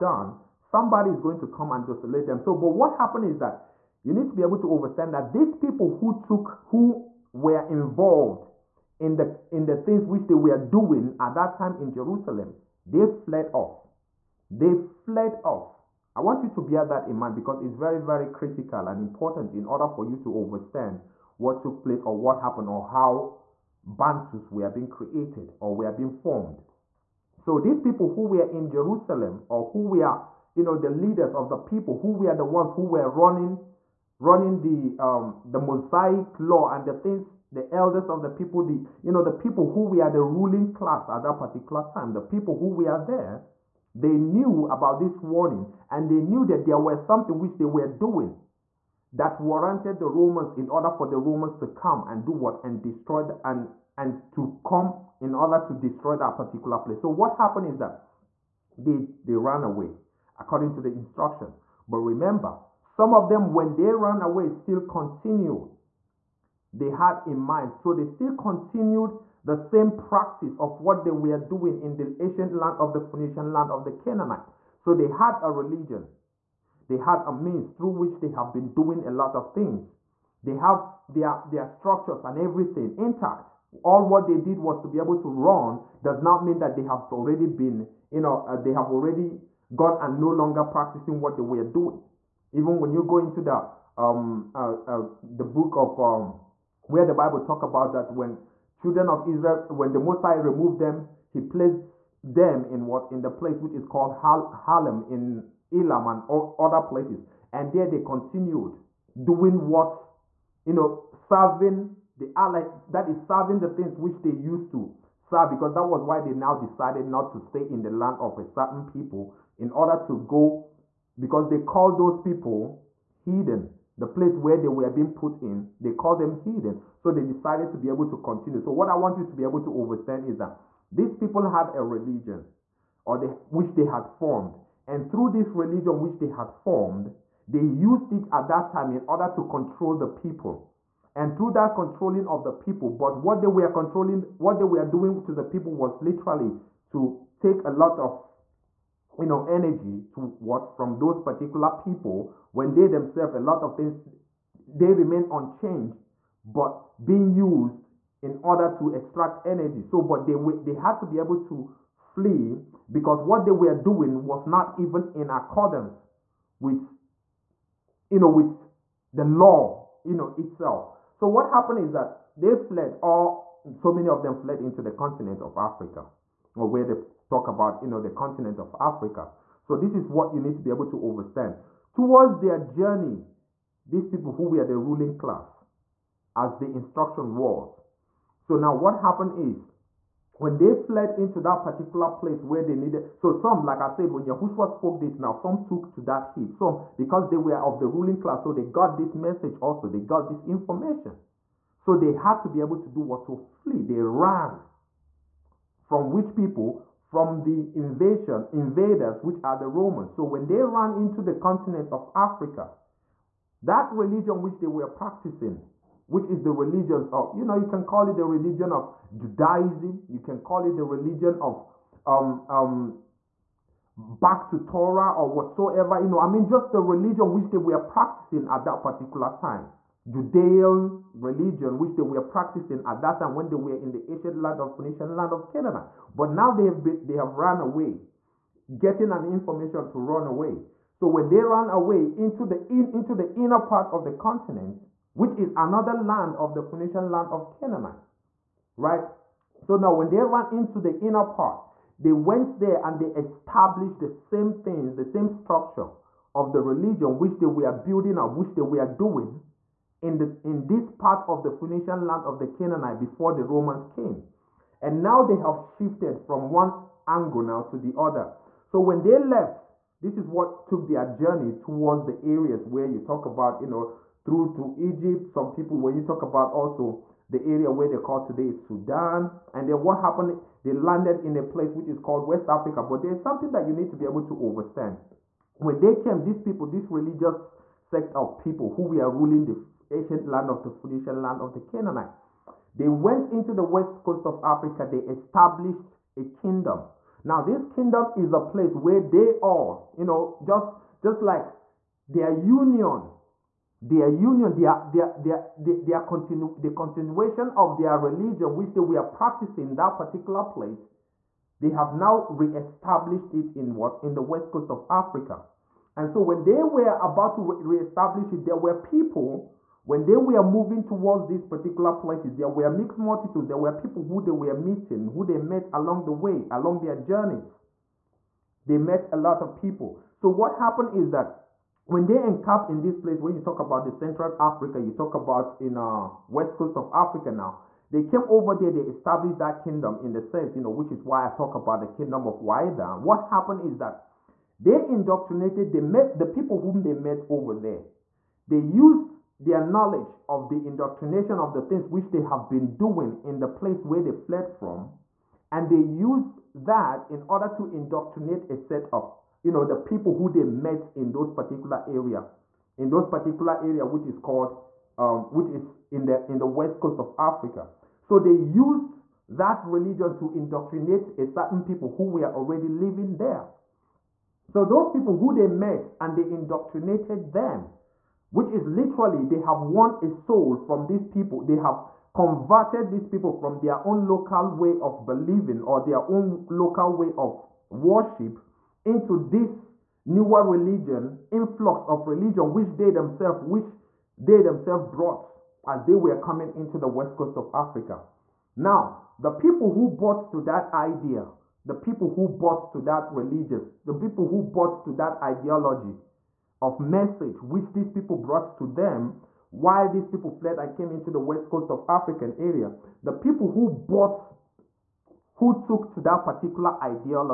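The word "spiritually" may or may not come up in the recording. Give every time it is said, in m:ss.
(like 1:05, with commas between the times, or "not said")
not said.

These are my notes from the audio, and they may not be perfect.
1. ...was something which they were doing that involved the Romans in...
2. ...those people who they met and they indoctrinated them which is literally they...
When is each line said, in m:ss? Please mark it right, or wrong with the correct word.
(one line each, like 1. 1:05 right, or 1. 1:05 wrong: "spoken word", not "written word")
1. 0:46 wrong: "warranted", not "involved"
2. 6:14 right.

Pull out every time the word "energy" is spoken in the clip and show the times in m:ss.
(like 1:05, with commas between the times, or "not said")
2:29, 2:39.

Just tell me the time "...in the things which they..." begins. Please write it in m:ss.
0:09.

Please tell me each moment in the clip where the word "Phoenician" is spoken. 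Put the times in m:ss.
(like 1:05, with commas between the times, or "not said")
1:12, 3:54, 4:06, 4:21, 4:50.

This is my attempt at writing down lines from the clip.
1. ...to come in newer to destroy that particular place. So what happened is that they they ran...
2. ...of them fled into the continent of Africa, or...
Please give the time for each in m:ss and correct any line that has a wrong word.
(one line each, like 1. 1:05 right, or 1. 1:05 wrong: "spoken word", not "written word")
1. 0:54 wrong: "order", not "newer"
2. 2:54 right.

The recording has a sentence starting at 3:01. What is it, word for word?
Towards their journey, these people who were the ruling class, as the instruction was.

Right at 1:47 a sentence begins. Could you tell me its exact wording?
And there they continued doing what?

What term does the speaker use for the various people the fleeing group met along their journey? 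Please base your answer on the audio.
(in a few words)
Mixed multitudes.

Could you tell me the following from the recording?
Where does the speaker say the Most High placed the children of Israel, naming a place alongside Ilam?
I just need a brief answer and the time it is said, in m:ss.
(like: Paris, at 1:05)
Harlem, at 1:44.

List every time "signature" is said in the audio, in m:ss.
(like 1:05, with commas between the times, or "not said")
not said.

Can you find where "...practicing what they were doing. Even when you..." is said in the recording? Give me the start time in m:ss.
1:30.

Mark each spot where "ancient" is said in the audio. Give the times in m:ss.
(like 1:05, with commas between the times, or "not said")
1:12, 3:54, 4:49.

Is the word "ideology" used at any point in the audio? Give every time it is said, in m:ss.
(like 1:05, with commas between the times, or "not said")
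6:45, 6:56.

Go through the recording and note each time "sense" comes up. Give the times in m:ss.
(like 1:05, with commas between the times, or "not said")
5:40.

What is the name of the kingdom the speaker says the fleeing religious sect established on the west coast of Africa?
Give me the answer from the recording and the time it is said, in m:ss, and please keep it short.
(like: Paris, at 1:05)
Kingdom of Waida, at 5:41.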